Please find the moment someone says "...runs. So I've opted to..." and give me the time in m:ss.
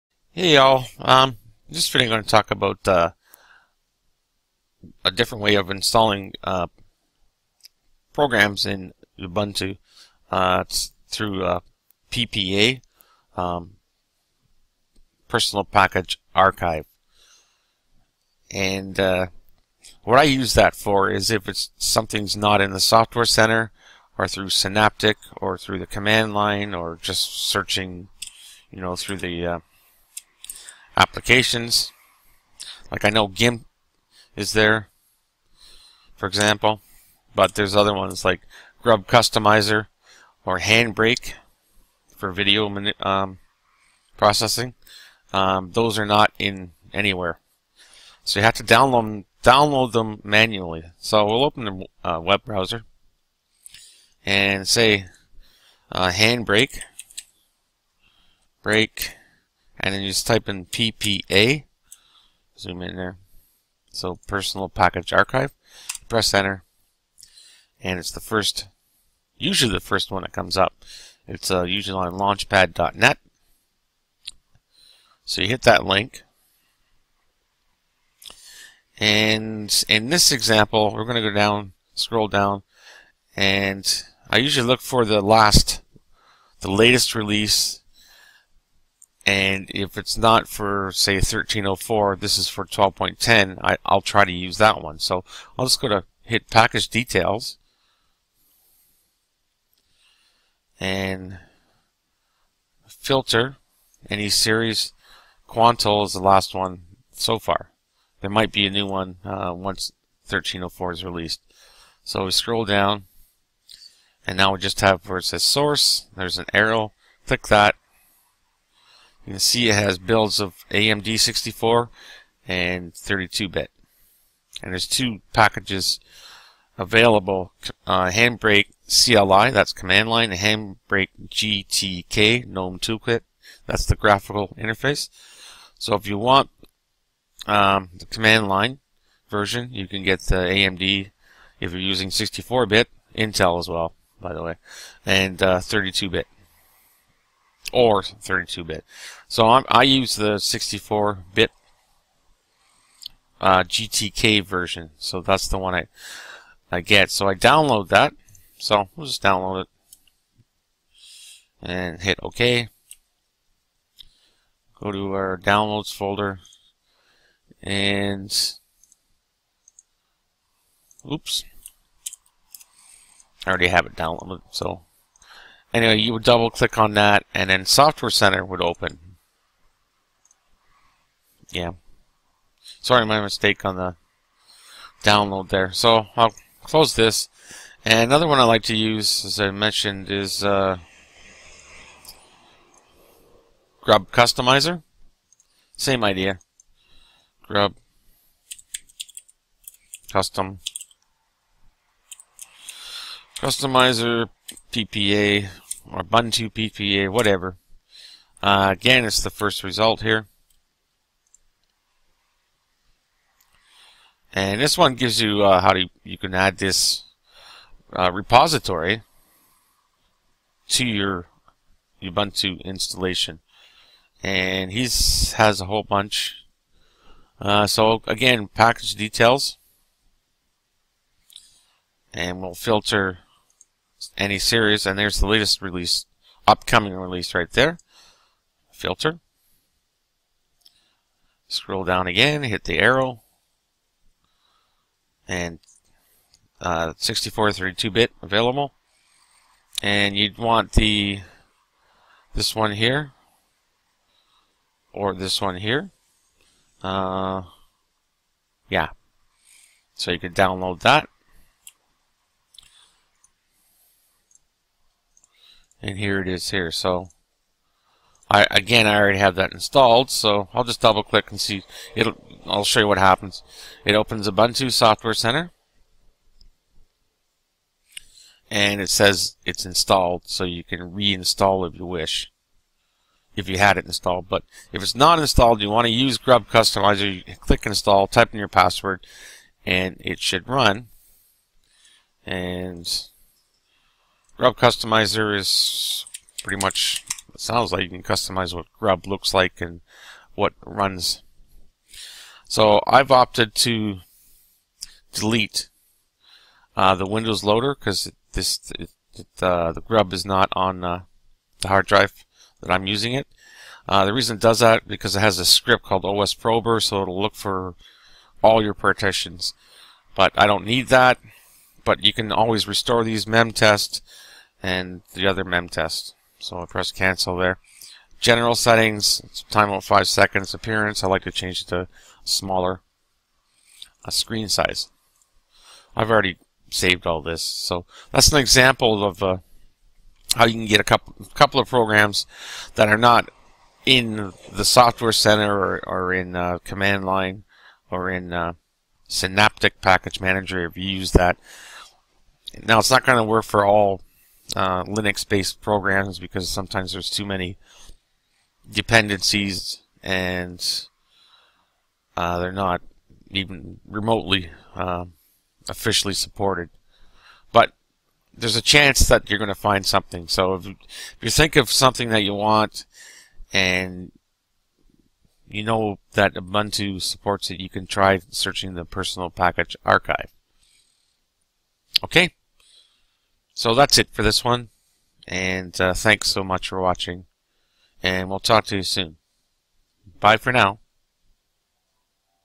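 5:00.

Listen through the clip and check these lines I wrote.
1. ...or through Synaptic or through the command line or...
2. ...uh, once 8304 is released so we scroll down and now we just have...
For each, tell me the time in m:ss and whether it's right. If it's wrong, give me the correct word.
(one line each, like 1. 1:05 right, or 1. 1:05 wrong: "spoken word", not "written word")
1. 0:24 right
2. 1:49 wrong: "1304", not "8304".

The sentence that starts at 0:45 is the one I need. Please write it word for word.
Um, those are not in anywhere.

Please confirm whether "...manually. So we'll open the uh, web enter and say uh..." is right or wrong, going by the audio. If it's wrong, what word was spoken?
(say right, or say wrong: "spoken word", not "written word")
wrong: "browser", not "enter".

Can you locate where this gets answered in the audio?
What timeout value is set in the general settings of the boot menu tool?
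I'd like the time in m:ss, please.
5:29.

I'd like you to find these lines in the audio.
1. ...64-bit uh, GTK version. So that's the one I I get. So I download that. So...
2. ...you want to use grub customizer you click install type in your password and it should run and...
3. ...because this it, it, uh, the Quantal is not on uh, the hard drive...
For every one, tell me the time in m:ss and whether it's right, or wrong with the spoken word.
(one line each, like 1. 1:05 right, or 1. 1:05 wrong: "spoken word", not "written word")
1. 2:30 right
2. 4:45 right
3. 5:07 wrong: "Grub", not "Quantal".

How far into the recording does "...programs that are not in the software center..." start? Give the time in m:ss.
5:41.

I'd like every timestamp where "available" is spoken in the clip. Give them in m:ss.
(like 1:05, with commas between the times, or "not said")
2:06, 4:08.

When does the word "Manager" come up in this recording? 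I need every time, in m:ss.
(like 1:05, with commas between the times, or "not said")
5:50.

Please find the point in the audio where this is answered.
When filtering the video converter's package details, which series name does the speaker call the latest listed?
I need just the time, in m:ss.
1:45.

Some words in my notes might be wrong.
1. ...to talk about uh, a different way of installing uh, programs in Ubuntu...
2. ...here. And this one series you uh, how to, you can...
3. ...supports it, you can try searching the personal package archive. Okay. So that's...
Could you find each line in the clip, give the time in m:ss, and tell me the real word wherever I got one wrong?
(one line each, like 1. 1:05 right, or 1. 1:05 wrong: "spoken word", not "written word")
1. 0:02 right
2. 3:30 wrong: "gives", not "series"
3. 6:17 right.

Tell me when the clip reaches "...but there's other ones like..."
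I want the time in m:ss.
0:37.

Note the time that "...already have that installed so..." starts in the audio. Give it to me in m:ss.
4:28.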